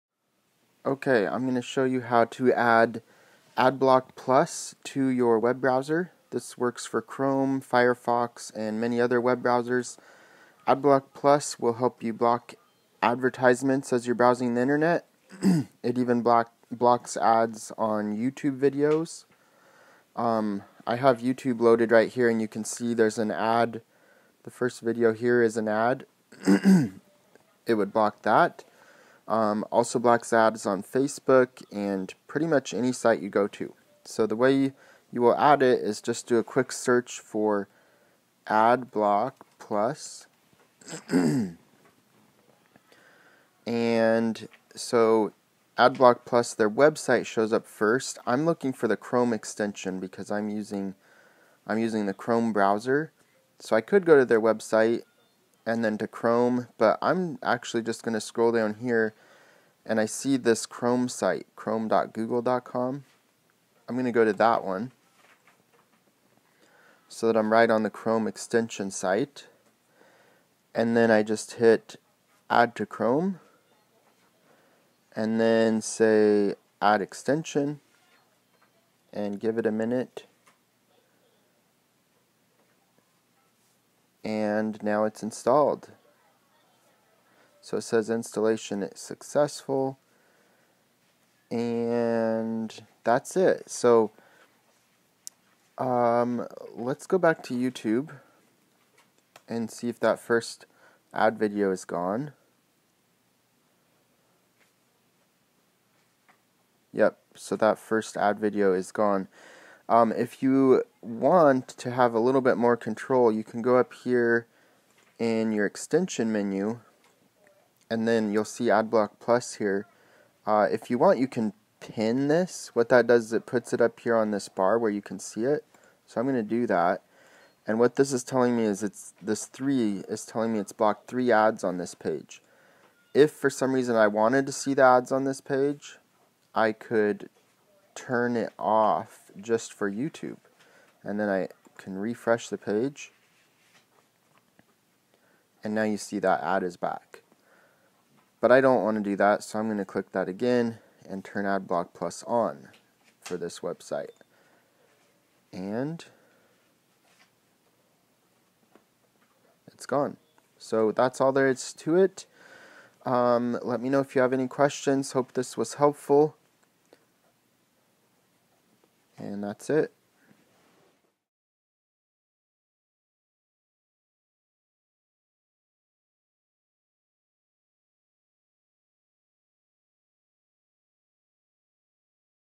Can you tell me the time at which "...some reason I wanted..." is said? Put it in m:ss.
2:13.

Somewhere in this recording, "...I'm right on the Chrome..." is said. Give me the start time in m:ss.
1:07.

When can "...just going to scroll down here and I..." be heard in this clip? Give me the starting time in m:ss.
0:57.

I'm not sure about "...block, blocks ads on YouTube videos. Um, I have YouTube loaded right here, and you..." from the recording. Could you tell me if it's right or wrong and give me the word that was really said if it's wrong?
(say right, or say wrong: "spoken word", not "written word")
right.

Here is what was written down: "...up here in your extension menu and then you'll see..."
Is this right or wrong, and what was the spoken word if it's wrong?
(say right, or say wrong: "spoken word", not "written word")
right.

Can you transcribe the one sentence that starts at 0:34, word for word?
So the way you will add it is just do a quick search for AdBlock Plus.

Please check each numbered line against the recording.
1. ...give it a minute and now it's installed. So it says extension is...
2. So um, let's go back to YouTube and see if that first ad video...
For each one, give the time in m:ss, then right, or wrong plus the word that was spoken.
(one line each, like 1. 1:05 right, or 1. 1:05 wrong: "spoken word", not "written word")
1. 1:19 wrong: "installation", not "extension"
2. 1:33 right.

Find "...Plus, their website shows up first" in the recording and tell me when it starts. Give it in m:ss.
0:46.